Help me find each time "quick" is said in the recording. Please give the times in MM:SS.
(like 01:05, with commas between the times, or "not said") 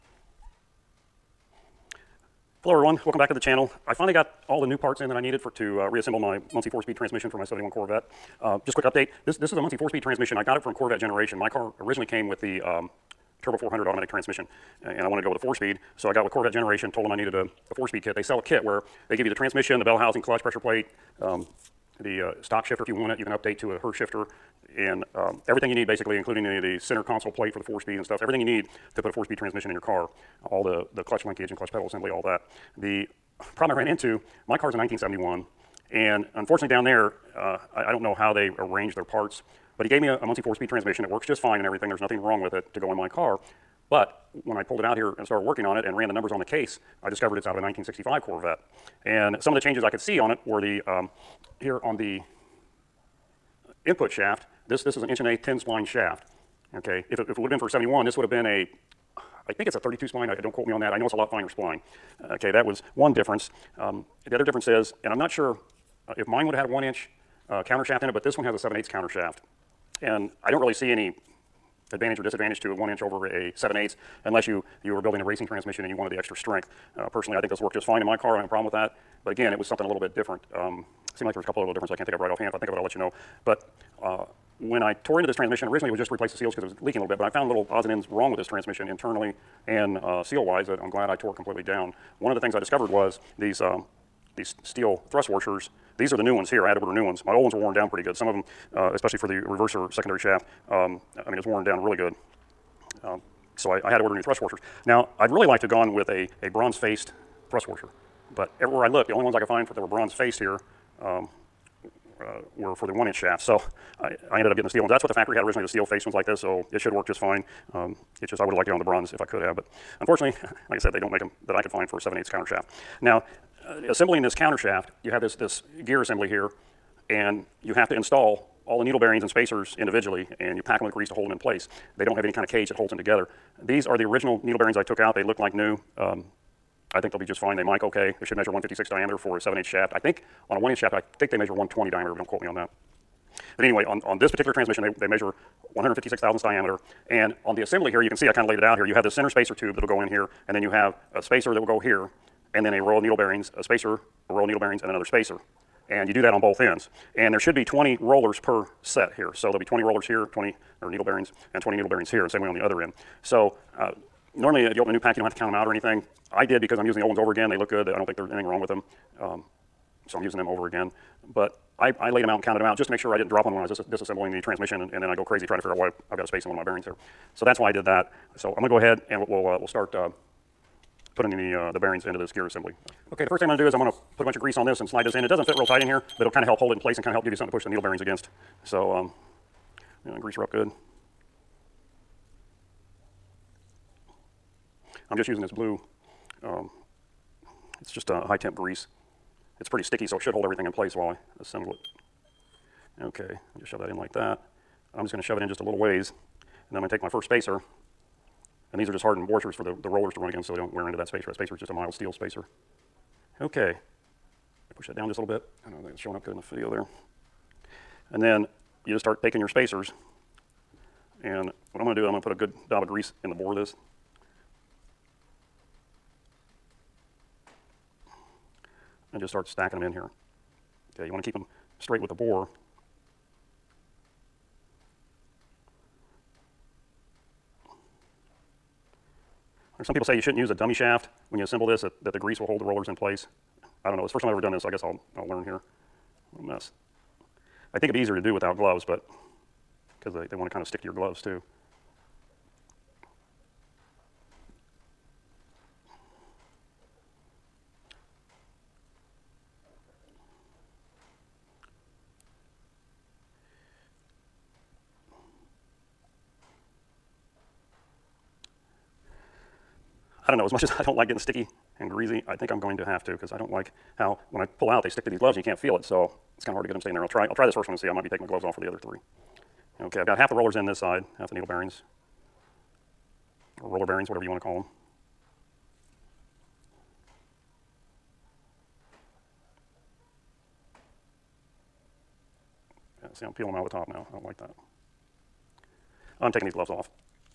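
00:08.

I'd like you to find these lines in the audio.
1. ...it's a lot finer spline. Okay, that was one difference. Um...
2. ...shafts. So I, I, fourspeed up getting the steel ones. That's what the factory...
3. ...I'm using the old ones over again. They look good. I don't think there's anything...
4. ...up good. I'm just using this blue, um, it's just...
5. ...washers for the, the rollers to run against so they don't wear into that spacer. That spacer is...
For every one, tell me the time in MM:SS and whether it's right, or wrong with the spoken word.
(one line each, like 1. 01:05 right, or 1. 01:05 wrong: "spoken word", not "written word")
1. 01:01 right
2. 01:53 wrong: "ended", not "fourspeed"
3. 02:46 right
4. 03:10 right
5. 03:29 right.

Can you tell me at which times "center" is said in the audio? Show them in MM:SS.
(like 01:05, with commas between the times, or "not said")
00:26, 02:29.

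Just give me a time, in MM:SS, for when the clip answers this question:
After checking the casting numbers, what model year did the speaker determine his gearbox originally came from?
00:47.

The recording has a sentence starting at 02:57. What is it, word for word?
So that's why I did that.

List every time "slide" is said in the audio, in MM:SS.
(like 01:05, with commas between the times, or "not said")
03:04.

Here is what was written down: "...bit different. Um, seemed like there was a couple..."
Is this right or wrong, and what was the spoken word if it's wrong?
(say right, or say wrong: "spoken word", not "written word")
right.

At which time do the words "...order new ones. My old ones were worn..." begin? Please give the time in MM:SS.
01:36.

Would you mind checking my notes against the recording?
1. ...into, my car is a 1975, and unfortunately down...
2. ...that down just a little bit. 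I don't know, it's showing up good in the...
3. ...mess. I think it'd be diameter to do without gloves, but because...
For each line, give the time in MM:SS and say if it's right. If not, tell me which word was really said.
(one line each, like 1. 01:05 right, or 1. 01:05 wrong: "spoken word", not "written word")
1. 00:33 wrong: "1971", not "1975"
2. 03:34 right
3. 04:06 wrong: "easier", not "diameter".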